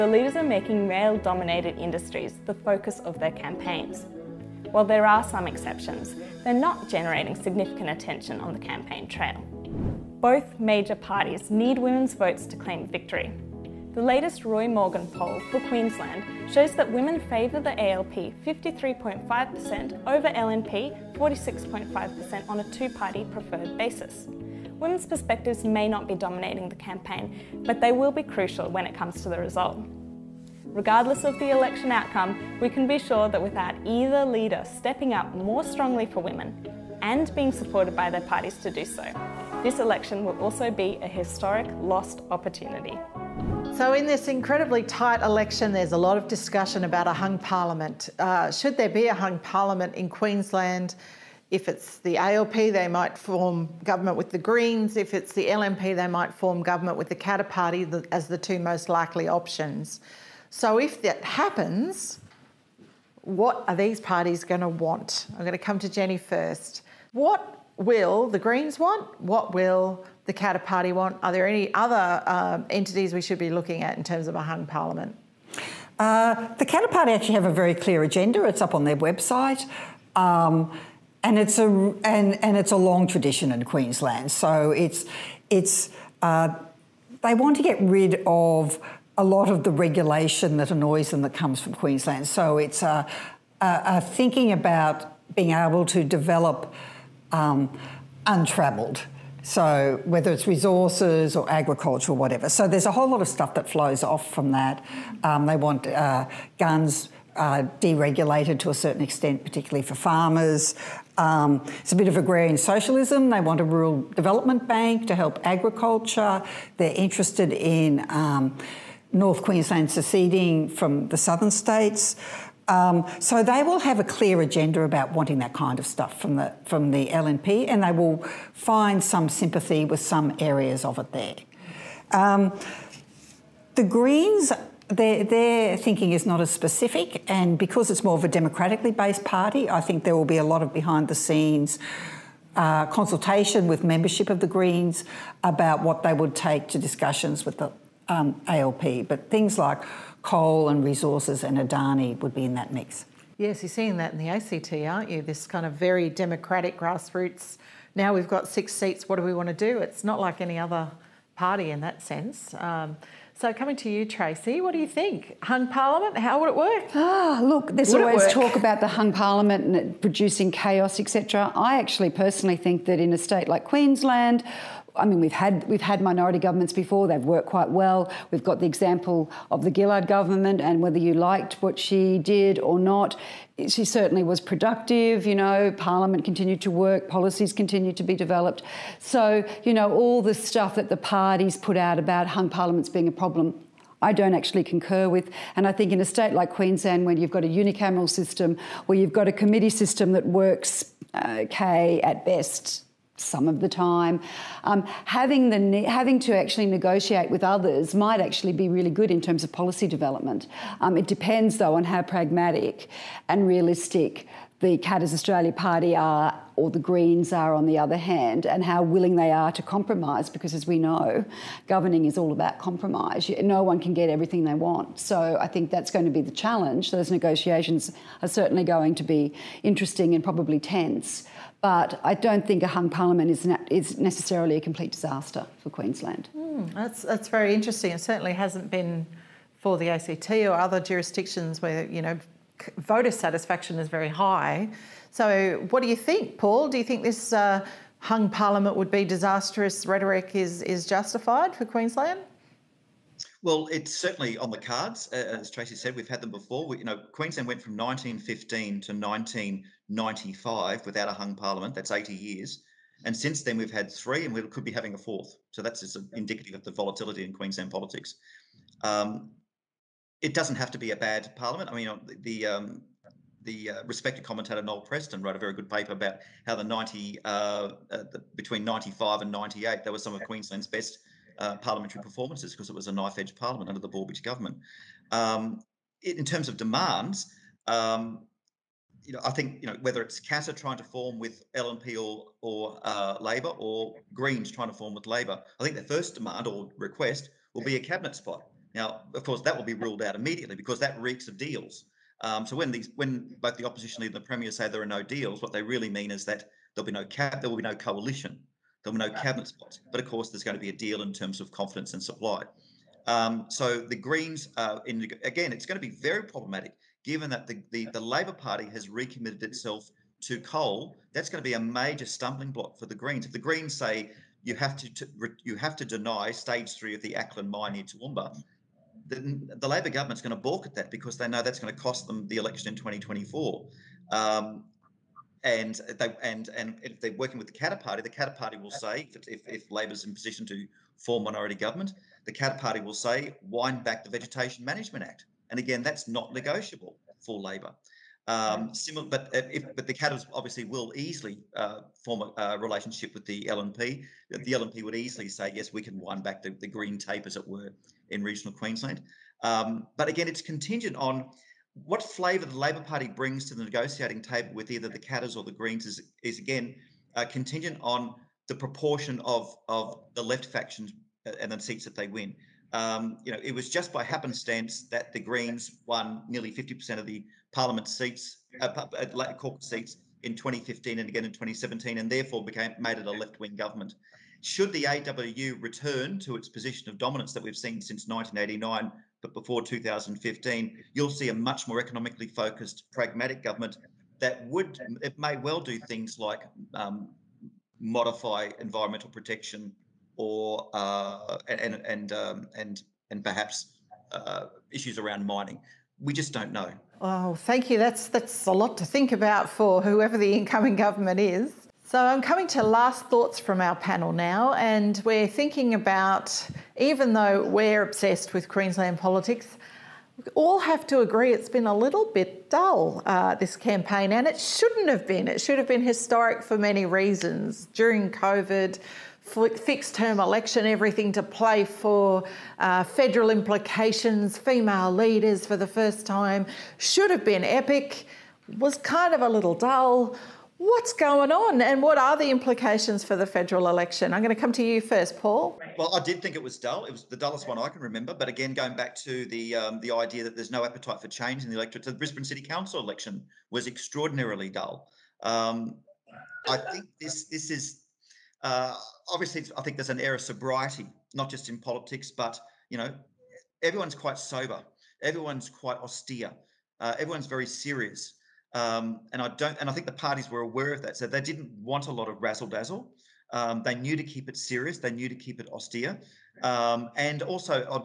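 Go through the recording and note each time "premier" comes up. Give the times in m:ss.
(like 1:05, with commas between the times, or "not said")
5:04.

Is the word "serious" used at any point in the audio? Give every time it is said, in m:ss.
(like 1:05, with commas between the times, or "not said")
7:47, 7:54.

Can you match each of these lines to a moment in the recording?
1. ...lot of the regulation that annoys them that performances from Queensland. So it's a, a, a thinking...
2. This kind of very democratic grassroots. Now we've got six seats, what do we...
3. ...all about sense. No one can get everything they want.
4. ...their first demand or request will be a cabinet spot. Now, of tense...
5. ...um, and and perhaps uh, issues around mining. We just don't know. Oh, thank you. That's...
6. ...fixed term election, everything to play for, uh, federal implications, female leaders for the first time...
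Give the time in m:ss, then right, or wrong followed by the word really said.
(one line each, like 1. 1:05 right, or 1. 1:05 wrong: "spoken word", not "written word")
1. 1:29 wrong: "comes", not "performances"
2. 2:35 right
3. 3:42 wrong: "compromise", not "sense"
4. 4:55 wrong: "course", not "tense"
5. 6:42 right
6. 7:09 right.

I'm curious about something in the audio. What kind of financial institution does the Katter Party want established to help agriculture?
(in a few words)
rural development bank.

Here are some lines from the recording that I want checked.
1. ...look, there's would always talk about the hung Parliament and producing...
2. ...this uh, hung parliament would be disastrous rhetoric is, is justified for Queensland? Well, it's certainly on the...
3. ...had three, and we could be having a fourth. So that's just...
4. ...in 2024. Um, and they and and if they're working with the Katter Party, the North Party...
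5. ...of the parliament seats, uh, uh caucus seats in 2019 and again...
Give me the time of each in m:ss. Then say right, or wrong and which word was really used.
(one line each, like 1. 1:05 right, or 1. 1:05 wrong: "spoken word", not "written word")
1. 2:47 right
2. 4:07 right
3. 4:23 right
4. 5:32 wrong: "Katter", not "North"
5. 6:16 wrong: "2015", not "2019".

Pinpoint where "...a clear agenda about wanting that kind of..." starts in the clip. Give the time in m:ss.
2:03.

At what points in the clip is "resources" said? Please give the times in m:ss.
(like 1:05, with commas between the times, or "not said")
1:40, 2:30.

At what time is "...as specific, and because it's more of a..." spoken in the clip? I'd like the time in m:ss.
2:16.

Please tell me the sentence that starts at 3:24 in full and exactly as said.
Um, having, the, having to actually negotiate with others might actually be really good in terms of policy development.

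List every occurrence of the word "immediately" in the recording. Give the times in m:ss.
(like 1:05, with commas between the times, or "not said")
5:00.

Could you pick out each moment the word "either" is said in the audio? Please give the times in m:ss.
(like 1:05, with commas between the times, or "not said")
0:33, 6:04.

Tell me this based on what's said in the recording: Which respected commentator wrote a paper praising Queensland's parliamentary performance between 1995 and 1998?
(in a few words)
Noel Preston.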